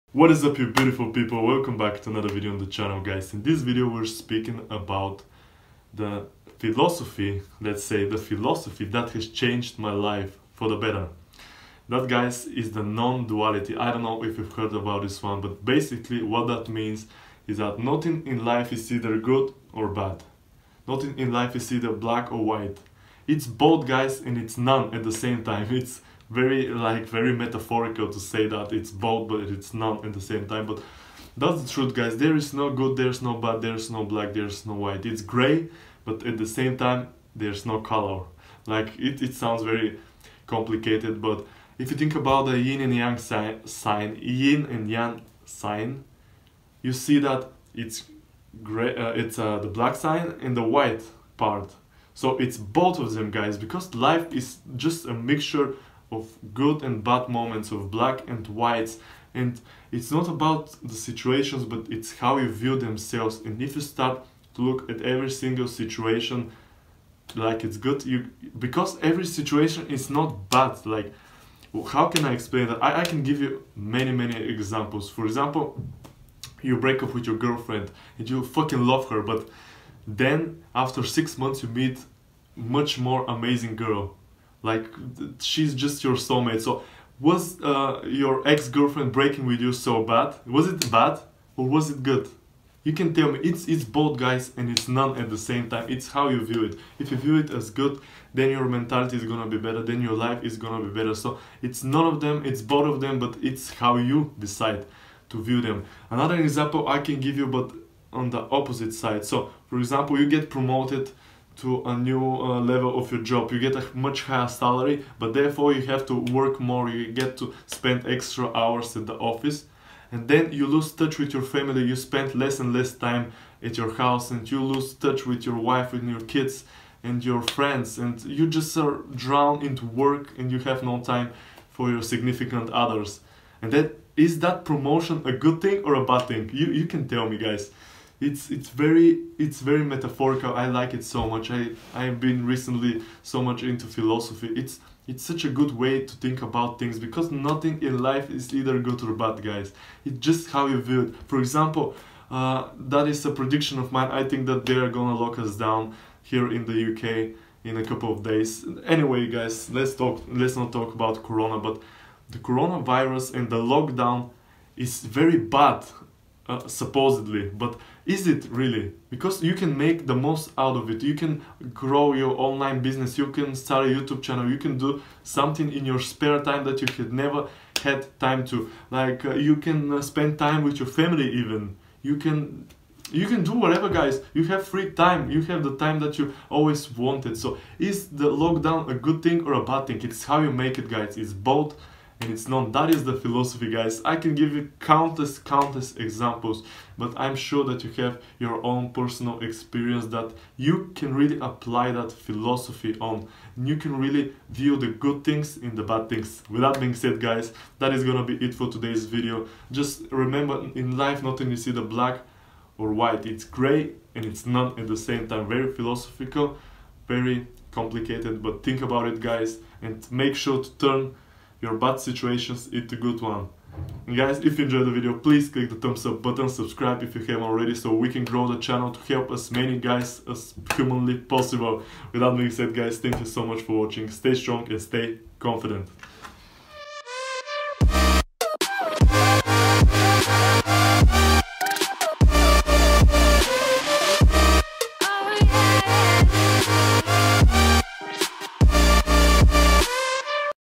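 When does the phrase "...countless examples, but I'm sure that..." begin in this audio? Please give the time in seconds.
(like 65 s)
195 s.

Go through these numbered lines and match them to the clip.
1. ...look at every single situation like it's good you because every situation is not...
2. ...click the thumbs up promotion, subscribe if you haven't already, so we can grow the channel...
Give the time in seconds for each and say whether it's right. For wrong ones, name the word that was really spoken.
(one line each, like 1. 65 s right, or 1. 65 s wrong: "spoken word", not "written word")
1. 64 s right
2. 225 s wrong: "button", not "promotion".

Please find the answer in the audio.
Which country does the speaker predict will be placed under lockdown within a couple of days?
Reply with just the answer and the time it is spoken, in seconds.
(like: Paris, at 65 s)
UK, at 156 s.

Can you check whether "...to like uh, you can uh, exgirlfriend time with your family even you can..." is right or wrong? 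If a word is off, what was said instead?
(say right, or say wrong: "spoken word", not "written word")
wrong: "spend", not "exgirlfriend".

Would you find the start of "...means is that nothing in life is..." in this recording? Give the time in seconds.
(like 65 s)
16 s.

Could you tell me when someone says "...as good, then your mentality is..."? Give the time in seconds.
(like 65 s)
97 s.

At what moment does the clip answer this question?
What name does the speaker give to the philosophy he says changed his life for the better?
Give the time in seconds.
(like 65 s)
12 s.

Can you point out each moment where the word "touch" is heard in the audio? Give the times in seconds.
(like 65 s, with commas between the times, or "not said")
120 s, 124 s.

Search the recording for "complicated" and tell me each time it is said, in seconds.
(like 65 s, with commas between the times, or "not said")
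40 s, 217 s.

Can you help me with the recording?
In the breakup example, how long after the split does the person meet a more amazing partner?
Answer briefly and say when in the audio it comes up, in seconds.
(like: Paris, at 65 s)
6 months, at 81 s.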